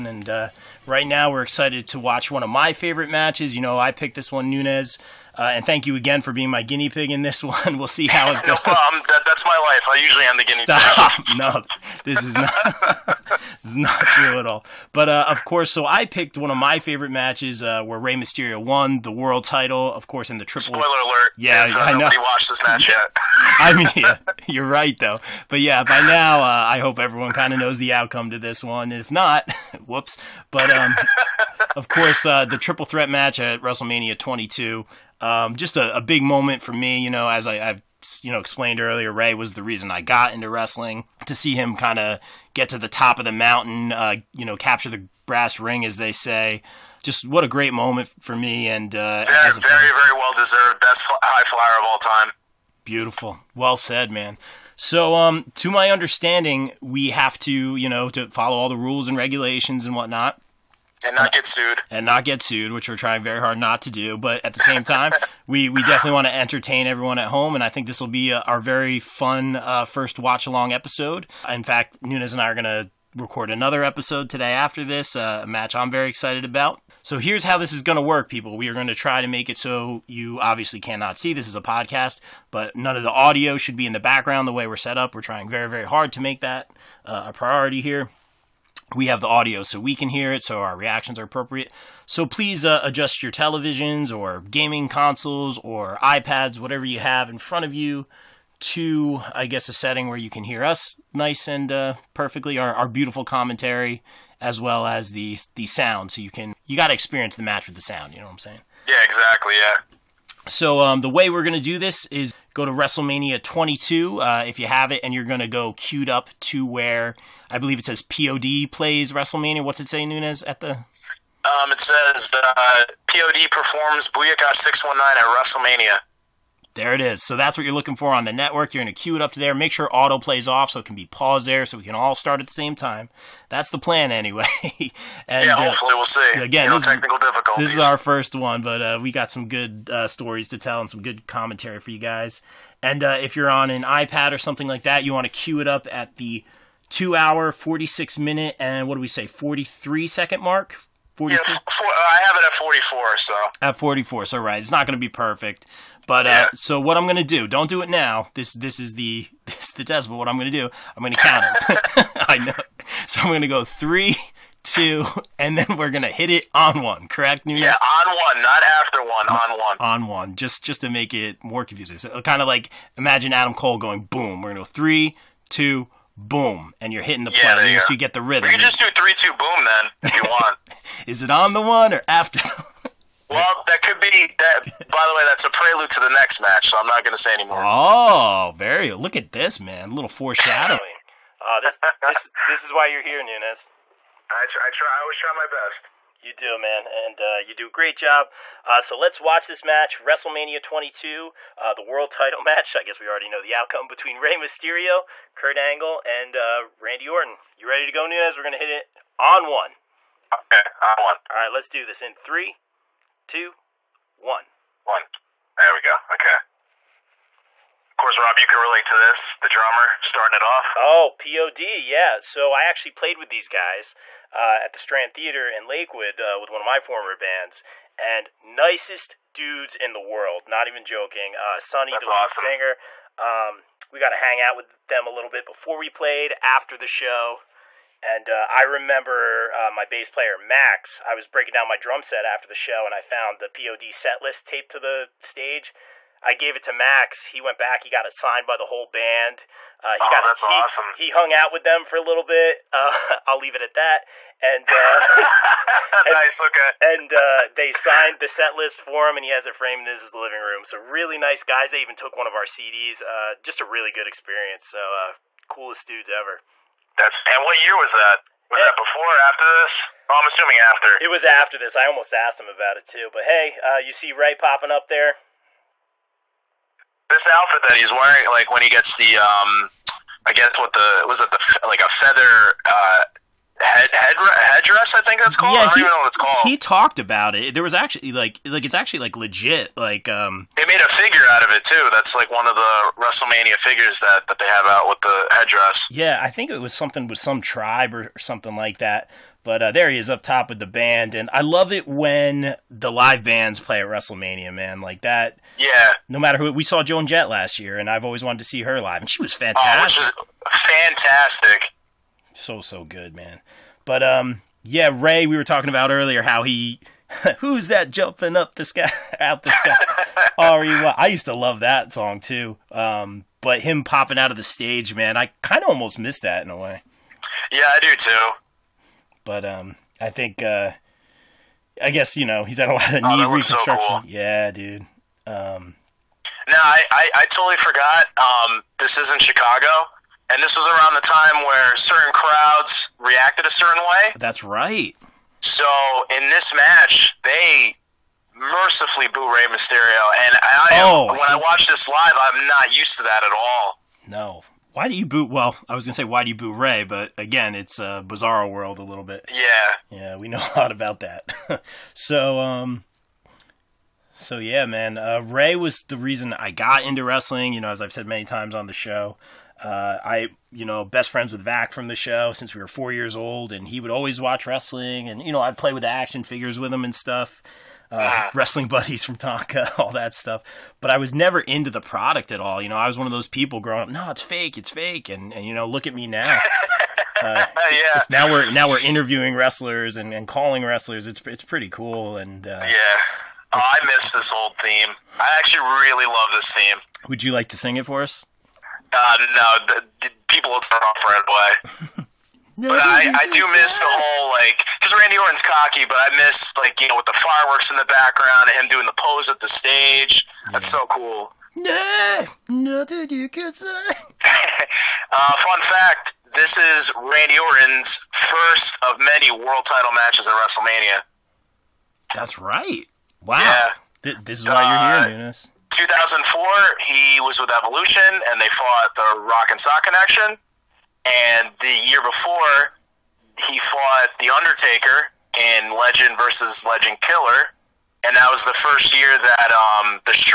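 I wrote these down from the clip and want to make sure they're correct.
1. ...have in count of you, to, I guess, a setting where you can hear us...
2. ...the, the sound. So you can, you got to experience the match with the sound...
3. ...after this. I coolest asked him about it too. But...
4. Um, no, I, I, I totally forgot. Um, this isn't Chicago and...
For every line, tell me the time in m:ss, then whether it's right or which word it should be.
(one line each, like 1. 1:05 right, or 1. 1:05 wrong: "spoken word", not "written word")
1. 1:36 wrong: "front", not "count"
2. 1:45 right
3. 4:31 wrong: "almost", not "coolest"
4. 5:35 right.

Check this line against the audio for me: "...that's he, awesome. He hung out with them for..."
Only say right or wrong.
right.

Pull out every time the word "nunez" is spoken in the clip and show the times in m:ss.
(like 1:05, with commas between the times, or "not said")
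0:04, 1:12, 2:00, 2:47, 3:13, 3:28, 7:05.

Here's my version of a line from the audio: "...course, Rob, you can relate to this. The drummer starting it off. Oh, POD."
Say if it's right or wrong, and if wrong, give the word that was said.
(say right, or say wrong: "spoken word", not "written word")
right.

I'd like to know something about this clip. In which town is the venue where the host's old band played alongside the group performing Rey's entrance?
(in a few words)
Lakewood.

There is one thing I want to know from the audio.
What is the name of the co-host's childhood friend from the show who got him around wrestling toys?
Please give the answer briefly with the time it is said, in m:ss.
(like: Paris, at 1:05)
Vac, at 6:11.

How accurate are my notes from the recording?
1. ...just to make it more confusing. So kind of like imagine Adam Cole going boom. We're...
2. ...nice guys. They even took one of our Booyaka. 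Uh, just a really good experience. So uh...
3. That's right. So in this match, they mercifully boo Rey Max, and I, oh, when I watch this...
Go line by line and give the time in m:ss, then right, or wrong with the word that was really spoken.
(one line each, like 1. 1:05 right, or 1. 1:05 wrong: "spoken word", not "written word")
1. 2:50 right
2. 4:21 wrong: "CDs", not "Booyaka"
3. 5:44 wrong: "Mysterio", not "Max".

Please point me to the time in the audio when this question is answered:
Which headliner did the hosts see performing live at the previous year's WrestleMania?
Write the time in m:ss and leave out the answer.
5:06.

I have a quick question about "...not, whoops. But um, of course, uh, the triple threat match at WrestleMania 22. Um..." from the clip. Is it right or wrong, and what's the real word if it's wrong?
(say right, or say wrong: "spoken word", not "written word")
right.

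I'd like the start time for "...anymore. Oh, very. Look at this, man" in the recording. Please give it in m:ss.
3:07.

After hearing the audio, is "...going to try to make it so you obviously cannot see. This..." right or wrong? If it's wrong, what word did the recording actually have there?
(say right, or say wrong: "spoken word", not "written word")
right.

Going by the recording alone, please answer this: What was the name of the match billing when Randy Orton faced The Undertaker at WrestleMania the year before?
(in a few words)
Legend versus Legend Killer.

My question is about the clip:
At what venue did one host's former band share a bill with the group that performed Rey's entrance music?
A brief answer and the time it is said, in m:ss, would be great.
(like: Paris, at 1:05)
Strand Theater, at 3:44.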